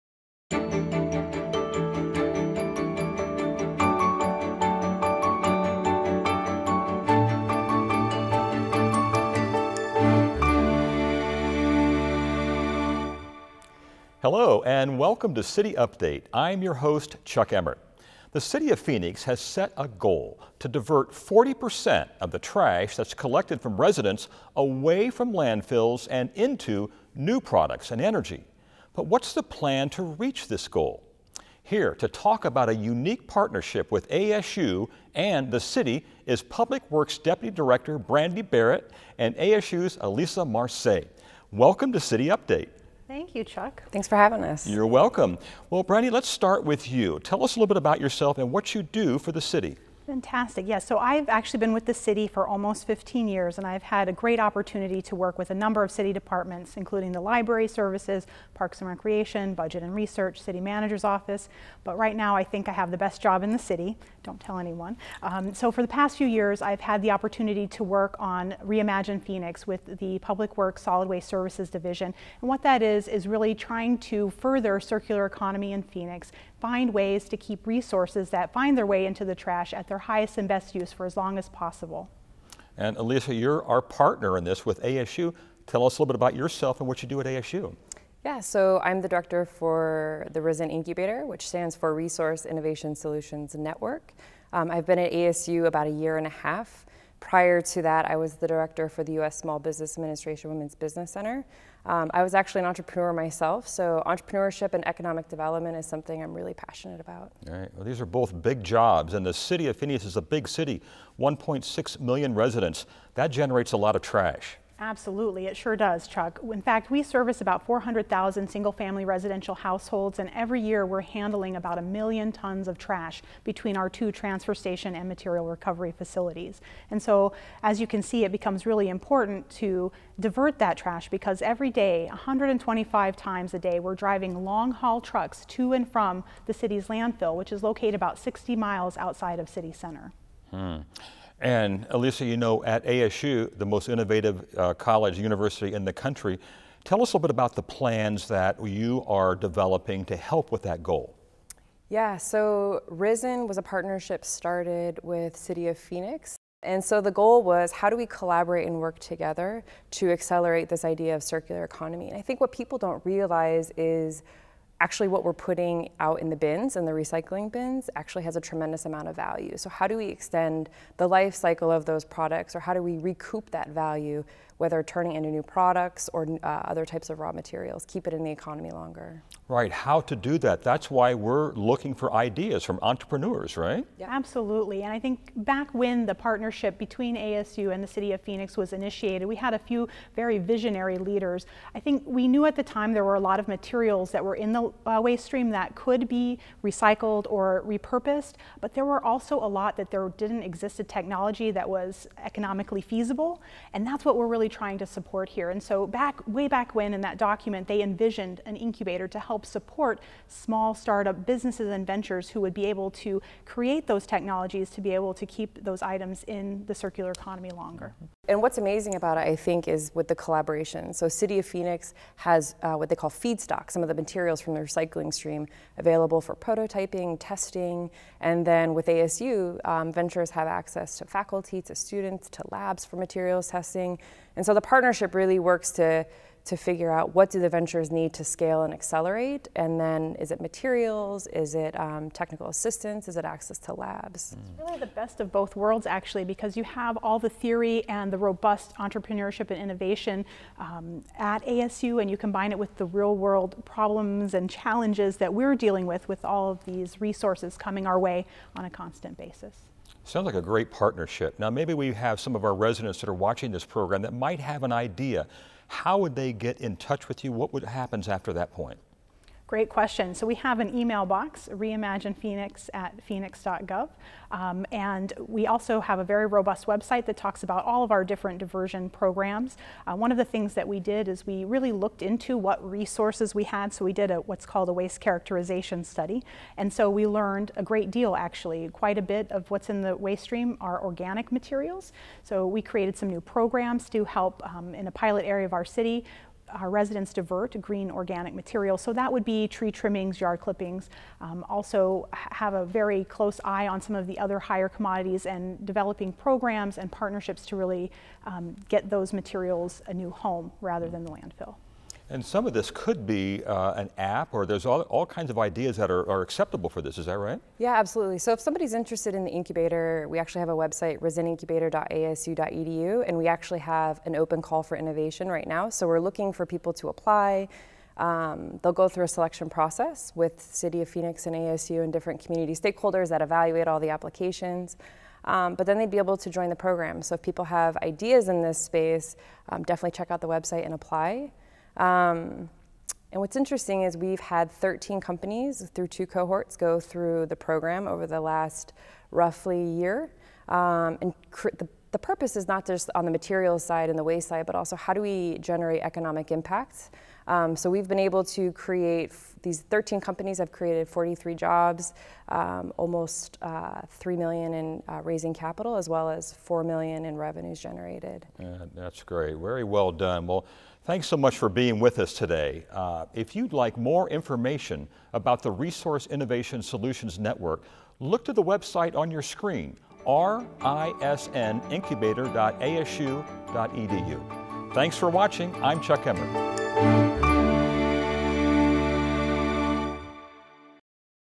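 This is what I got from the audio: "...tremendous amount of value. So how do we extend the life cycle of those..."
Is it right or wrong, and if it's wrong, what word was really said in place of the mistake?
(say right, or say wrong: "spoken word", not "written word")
right.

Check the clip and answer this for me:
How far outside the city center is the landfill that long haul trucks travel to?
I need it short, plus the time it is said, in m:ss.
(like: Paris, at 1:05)
60 miles, at 2:18.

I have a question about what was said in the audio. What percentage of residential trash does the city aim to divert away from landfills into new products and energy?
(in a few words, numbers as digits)
40%.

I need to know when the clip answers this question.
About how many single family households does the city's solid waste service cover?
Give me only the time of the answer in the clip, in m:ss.
1:57.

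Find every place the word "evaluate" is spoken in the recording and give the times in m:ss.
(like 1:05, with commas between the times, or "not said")
5:33.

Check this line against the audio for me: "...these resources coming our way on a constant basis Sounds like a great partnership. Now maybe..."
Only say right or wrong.
right.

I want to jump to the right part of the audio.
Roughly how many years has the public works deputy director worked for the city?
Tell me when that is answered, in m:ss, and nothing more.
0:52.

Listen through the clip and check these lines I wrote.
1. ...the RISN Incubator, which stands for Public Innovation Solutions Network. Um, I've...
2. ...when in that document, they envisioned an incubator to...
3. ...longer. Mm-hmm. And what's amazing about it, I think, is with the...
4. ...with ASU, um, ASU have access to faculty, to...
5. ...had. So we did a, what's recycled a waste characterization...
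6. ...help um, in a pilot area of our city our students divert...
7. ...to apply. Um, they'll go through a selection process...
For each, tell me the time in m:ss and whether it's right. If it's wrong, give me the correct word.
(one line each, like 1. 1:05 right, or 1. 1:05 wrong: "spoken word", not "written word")
1. 1:30 wrong: "Resource", not "Public"
2. 3:26 right
3. 3:37 right
4. 3:48 wrong: "Ventures", not "ASU"
5. 4:43 wrong: "called", not "recycled"
6. 4:54 wrong: "residents", not "students"
7. 5:26 right.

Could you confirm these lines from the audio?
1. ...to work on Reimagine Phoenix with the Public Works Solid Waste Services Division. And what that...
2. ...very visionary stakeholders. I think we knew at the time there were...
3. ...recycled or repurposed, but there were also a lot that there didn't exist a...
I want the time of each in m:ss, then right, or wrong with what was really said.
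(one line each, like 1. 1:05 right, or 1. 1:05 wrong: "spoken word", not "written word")
1. 1:07 right
2. 3:10 wrong: "leaders", not "stakeholders"
3. 3:16 right.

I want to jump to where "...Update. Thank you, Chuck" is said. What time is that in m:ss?
0:42.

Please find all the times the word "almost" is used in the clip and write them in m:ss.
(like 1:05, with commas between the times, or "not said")
0:52, 6:02.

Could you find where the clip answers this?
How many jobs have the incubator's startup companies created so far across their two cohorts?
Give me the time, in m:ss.
6:00.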